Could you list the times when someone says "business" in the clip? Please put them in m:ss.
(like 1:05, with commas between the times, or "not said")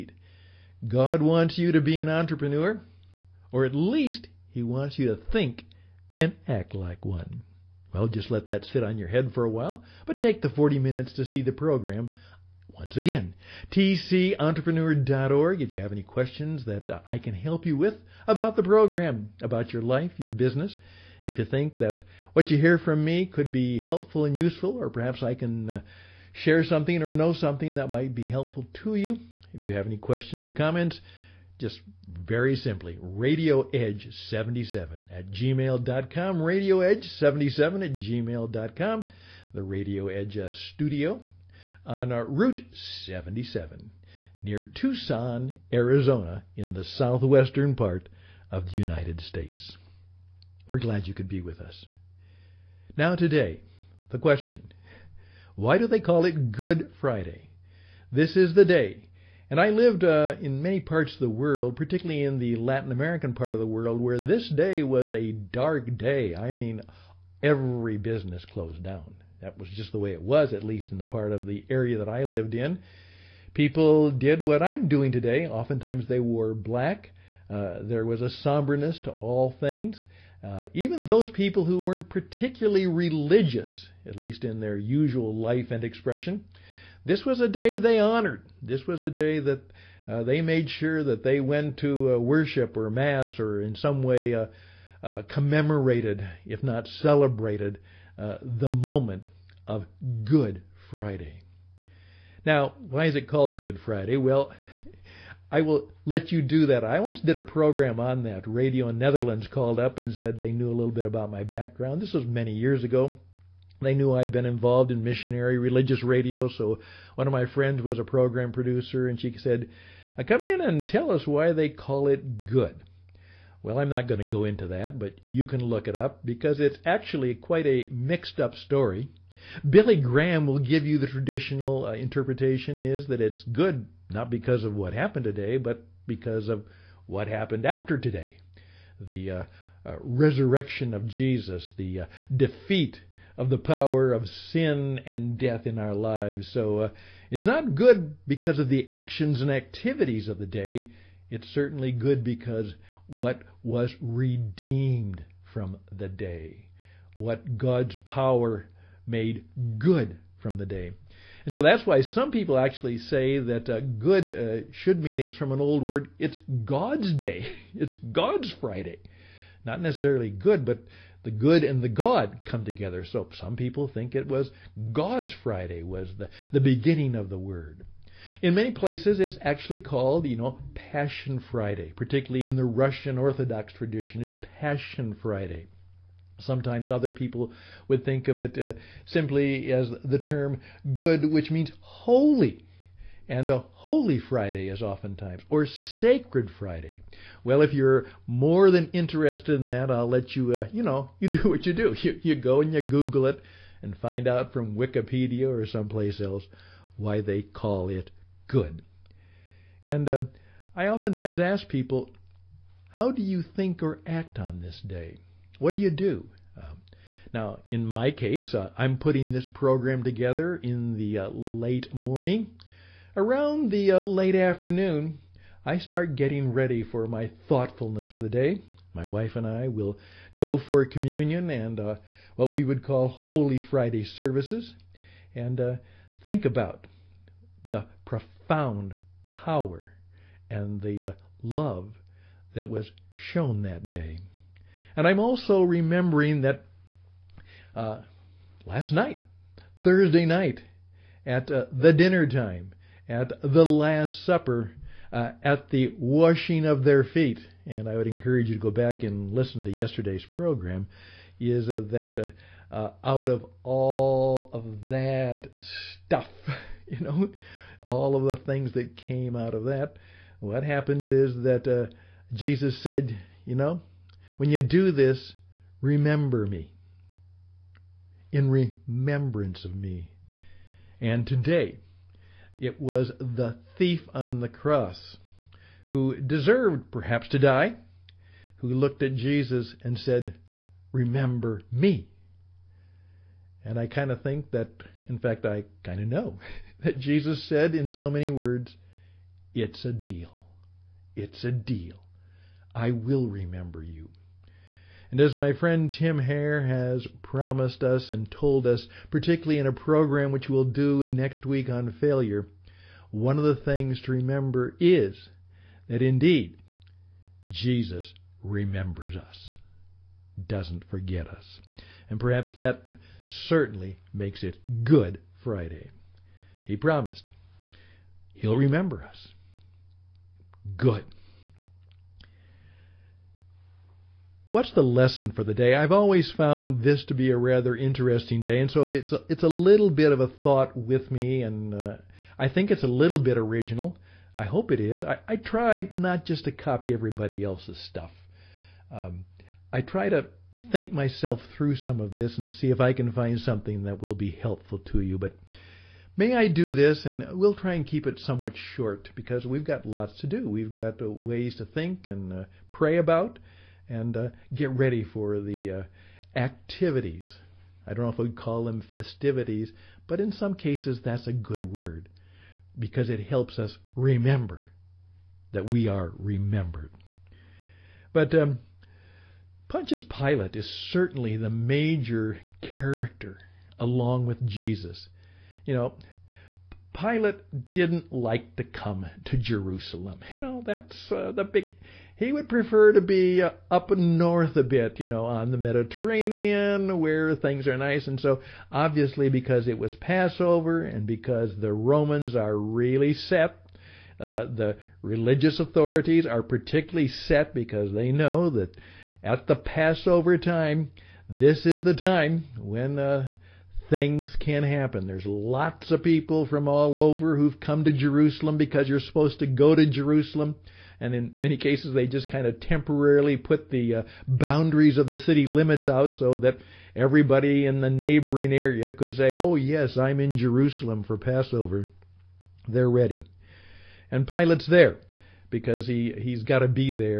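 0:20, 1:07.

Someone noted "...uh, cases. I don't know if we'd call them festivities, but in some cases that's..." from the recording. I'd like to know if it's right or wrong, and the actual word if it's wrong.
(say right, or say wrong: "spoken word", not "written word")
wrong: "activities", not "cases".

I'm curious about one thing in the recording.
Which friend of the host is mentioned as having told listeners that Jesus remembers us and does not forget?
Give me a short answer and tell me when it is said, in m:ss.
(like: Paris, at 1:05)
Tim Hare, at 5:05.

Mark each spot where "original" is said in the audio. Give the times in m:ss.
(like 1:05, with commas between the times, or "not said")
5:43.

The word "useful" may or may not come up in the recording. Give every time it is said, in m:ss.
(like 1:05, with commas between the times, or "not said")
0:24.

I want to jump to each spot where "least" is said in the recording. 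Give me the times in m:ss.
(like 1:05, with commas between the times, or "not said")
0:03, 1:10, 1:24.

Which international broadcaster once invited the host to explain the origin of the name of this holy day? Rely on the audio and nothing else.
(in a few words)
Radio Netherlands.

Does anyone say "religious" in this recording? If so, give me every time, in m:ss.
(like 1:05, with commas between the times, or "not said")
1:22, 1:55, 6:45.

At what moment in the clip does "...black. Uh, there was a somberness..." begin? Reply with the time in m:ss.
1:16.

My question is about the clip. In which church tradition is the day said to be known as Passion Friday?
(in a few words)
Russian Orthodox.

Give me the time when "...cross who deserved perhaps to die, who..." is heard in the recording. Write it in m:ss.
4:44.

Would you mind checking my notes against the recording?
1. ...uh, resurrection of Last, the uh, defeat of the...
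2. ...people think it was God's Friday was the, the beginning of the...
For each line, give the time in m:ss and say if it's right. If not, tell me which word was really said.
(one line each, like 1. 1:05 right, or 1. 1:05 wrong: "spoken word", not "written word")
1. 2:19 wrong: "Jesus", not "Last"
2. 2:53 right.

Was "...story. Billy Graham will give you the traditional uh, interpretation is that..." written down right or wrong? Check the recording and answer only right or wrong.
right.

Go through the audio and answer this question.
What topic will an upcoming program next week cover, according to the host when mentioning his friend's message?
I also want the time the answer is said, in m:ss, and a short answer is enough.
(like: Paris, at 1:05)
failure, at 5:12.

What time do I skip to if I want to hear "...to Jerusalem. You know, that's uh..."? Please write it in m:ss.
6:29.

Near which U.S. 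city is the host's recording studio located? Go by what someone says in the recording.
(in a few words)
Tucson.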